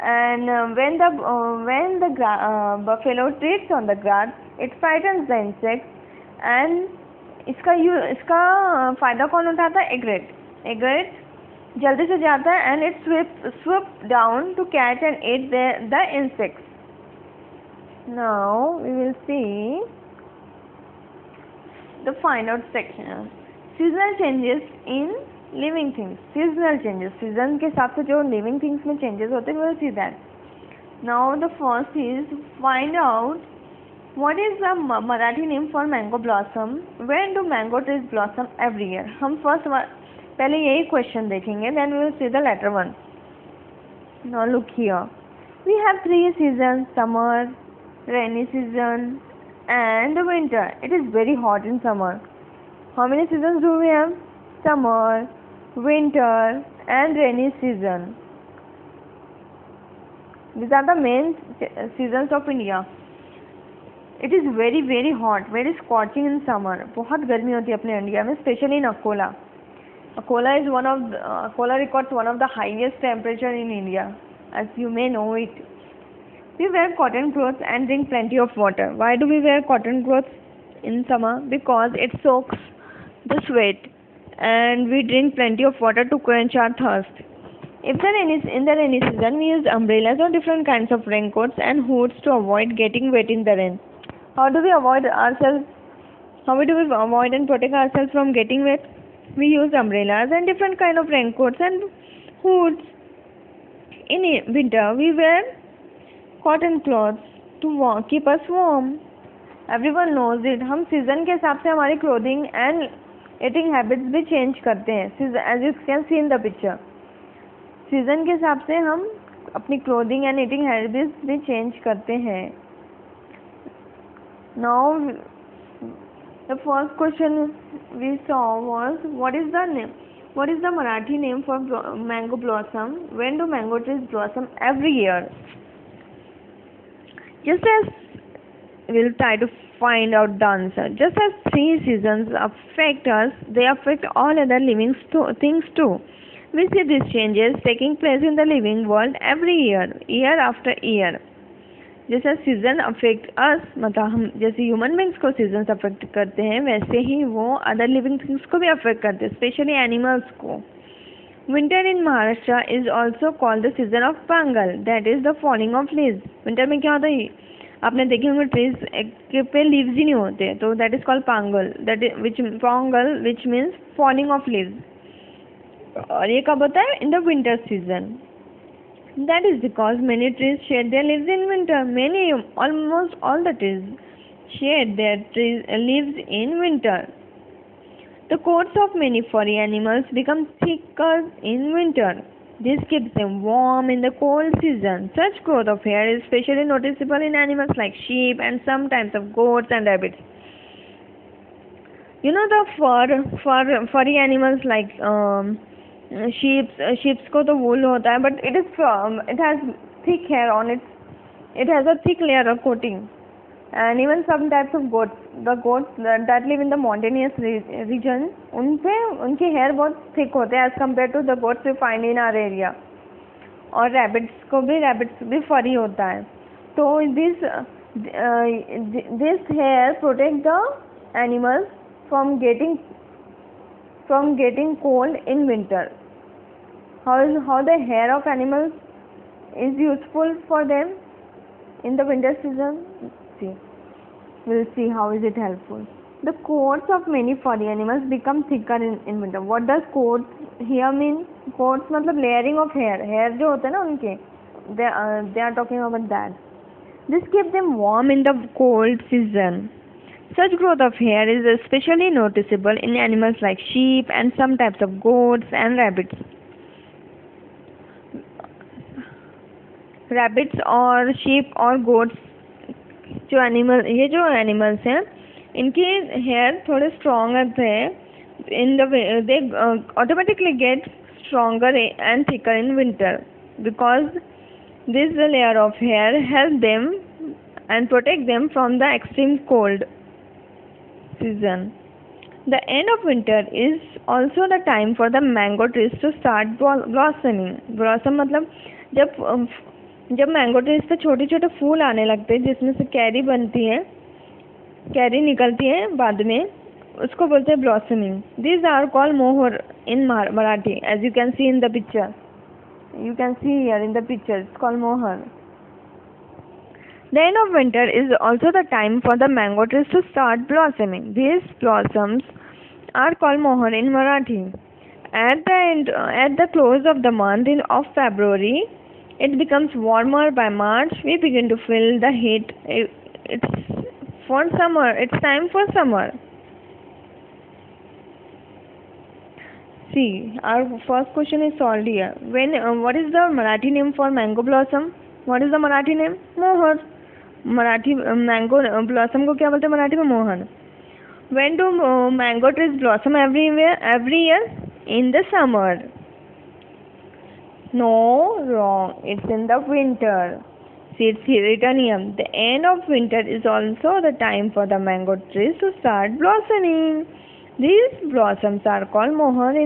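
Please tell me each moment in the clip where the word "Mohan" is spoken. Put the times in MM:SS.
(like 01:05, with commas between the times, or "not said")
05:46, 06:09.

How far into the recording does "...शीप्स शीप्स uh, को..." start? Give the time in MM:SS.
03:26.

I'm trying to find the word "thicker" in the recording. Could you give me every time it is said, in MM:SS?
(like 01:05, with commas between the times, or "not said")
03:10, 04:08.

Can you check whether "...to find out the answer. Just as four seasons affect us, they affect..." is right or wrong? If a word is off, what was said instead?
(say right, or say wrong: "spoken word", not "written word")
wrong: "three", not "four".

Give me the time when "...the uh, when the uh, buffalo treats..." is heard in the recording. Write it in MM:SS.
00:01.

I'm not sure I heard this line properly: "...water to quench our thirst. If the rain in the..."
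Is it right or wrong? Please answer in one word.
right.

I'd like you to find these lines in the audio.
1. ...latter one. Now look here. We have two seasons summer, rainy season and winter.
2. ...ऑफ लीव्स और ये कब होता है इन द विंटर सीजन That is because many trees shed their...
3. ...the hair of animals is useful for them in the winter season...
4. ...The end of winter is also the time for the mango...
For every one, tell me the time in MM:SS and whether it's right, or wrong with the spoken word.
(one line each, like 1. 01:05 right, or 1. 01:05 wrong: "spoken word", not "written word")
1. 00:42 wrong: "three", not "two"
2. 02:54 right
3. 03:57 right
4. 06:02 right.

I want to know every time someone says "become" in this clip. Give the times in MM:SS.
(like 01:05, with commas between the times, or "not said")
03:10, 04:08, 05:29.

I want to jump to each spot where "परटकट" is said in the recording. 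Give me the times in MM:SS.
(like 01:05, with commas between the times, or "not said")
03:50, 04:47.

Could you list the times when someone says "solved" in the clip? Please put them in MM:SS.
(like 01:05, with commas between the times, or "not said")
05:41.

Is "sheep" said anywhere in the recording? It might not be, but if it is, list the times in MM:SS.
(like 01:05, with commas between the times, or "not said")
03:18, 04:23.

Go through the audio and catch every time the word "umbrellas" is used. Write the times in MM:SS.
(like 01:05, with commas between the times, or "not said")
01:29, 01:39.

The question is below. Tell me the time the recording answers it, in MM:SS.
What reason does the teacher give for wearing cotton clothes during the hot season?
01:22.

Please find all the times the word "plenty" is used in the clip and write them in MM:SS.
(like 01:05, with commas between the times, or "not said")
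01:18, 01:25.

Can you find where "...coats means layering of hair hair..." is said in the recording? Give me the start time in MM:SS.
04:11.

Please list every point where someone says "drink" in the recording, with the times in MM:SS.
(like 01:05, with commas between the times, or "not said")
01:17, 01:25.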